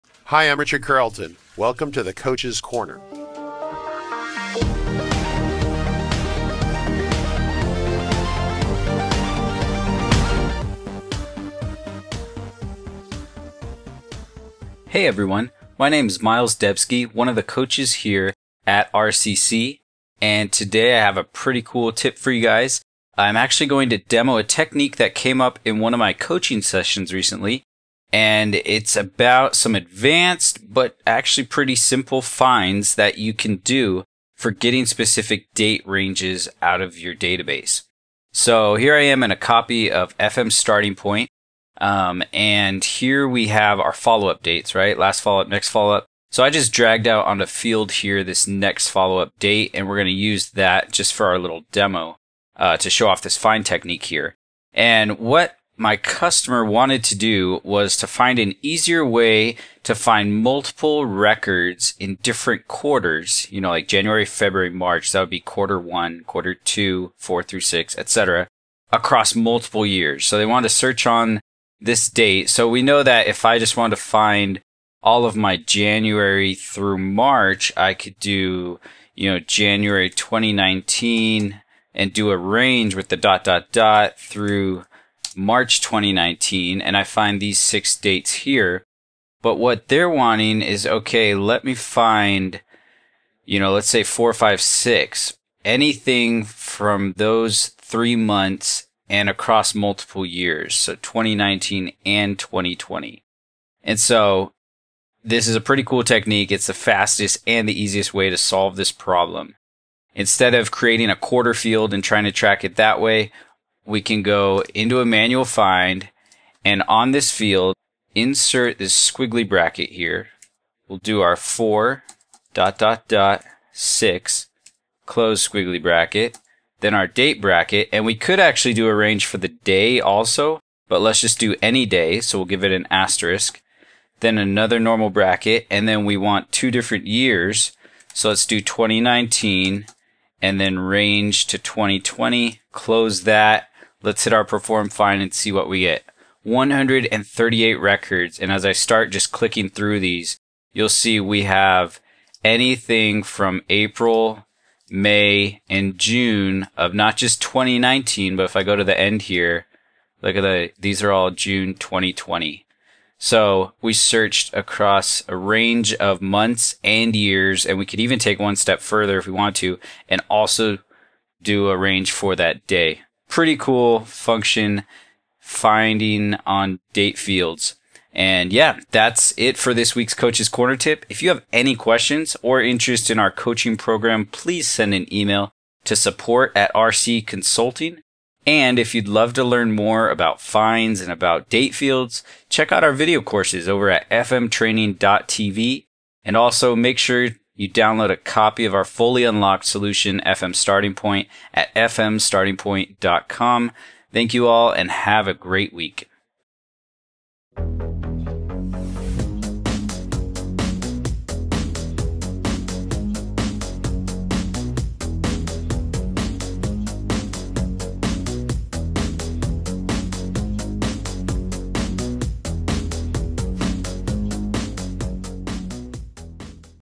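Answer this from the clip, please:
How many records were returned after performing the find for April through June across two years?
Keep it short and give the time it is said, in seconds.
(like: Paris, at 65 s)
138, at 146 s.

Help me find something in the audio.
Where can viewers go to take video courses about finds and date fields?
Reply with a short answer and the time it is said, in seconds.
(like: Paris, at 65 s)
fmtraining.tv, at 194 s.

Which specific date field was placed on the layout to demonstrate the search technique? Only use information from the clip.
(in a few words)
next follow-up date.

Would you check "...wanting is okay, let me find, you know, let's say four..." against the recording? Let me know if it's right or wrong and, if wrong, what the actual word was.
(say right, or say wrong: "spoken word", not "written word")
right.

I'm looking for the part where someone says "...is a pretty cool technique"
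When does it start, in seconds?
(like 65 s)
105 s.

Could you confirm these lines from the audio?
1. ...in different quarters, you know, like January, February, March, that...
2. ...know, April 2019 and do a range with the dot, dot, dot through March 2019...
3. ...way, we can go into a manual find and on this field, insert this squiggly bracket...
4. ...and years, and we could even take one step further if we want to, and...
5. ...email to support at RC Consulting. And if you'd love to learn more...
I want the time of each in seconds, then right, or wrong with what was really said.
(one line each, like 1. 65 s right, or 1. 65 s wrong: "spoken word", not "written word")
1. 61 s right
2. 79 s wrong: "January", not "April"
3. 113 s right
4. 166 s right
5. 185 s right.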